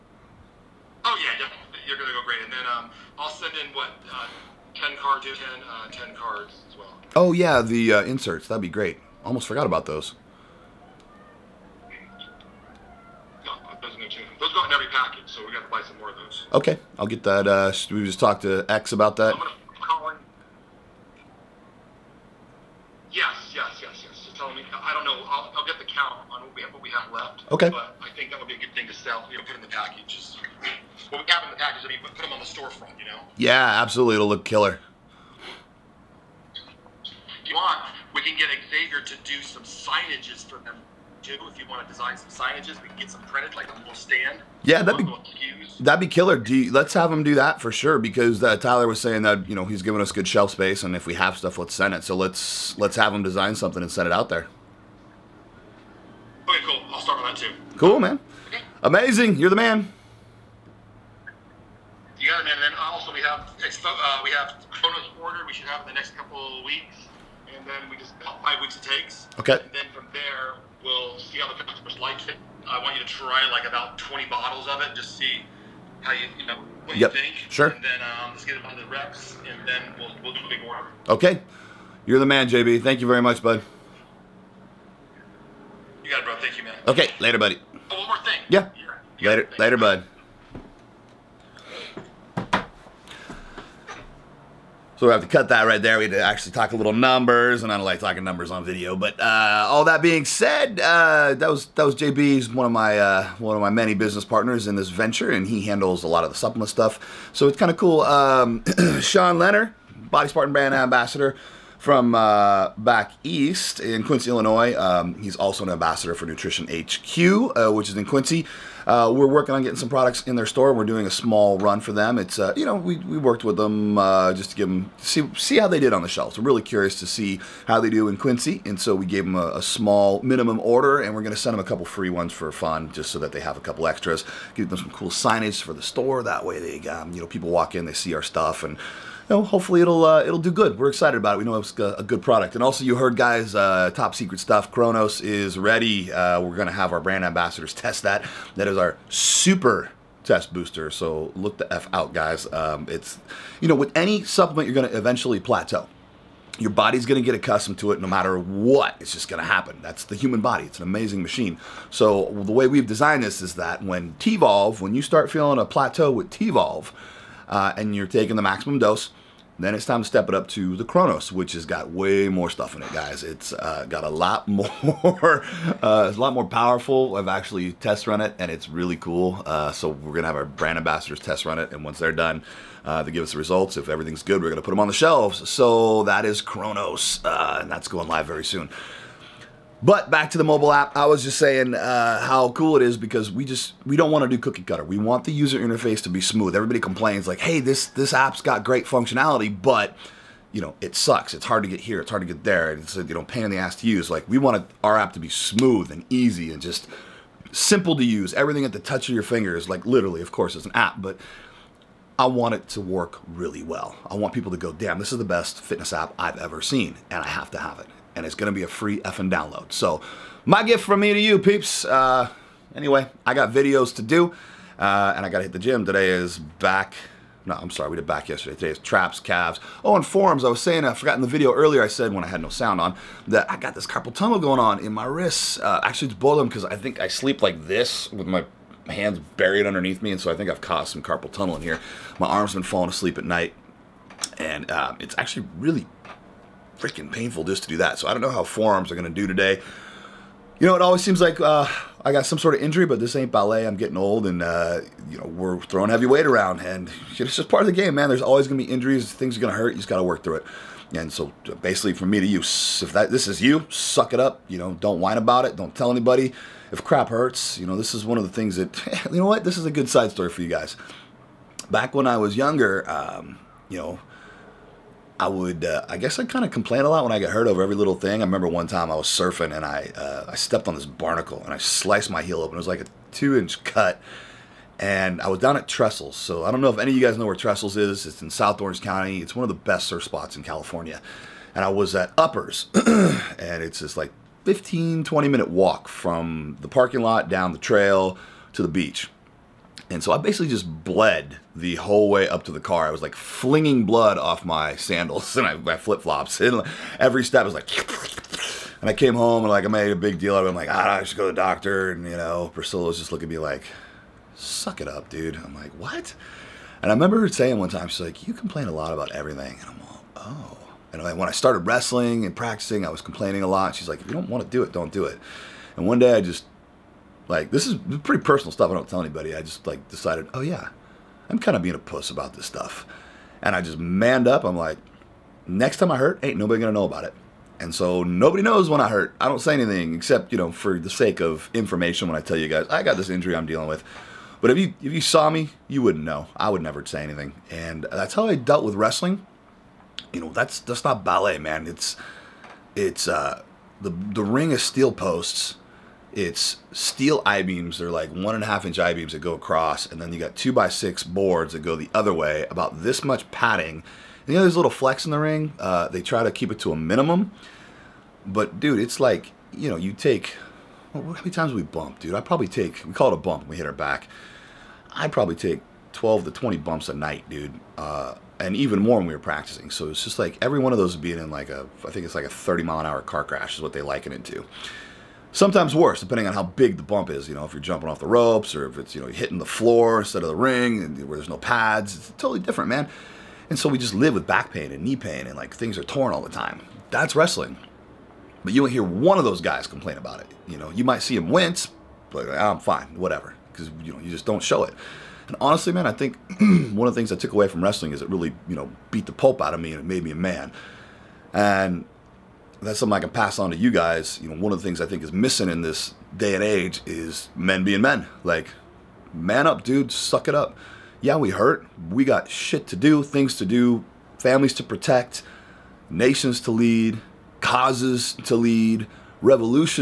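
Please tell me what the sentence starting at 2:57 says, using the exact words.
I've actually test run it, and it's really cool.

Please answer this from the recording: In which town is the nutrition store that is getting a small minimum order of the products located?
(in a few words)
Quincy, Illinois.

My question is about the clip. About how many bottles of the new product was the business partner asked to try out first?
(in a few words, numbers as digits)
20.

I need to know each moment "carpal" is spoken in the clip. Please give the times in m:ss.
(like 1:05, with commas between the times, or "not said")
3:53, 4:01.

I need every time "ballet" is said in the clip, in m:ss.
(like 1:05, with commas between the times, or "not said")
4:13, 5:51.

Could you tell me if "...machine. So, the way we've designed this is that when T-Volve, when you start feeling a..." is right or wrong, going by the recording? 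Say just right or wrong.
right.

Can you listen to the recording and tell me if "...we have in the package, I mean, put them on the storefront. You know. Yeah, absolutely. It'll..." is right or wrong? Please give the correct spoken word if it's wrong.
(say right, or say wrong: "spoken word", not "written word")
right.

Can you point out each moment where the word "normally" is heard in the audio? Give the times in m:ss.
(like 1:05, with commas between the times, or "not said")
not said.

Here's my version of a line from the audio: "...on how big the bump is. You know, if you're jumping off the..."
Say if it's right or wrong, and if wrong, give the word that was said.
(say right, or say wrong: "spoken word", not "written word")
right.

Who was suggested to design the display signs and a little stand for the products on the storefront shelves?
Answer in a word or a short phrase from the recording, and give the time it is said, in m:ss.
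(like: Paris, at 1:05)
Xavier, at 0:38.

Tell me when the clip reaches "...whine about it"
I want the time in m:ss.
4:25.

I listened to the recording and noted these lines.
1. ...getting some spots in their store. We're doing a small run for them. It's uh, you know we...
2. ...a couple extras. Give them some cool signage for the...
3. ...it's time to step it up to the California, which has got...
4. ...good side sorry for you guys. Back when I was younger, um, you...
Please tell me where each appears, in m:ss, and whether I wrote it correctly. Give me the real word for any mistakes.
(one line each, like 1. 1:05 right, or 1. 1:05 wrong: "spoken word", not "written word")
1. 1:59 wrong: "products", not "spots"
2. 2:13 right
3. 2:49 wrong: "Chronos", not "California"
4. 4:29 wrong: "story", not "sorry".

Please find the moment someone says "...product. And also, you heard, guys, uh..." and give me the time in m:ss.
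2:22.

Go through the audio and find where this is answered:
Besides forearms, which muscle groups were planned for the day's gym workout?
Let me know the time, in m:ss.
3:48.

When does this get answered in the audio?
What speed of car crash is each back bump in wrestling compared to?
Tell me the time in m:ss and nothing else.
6:22.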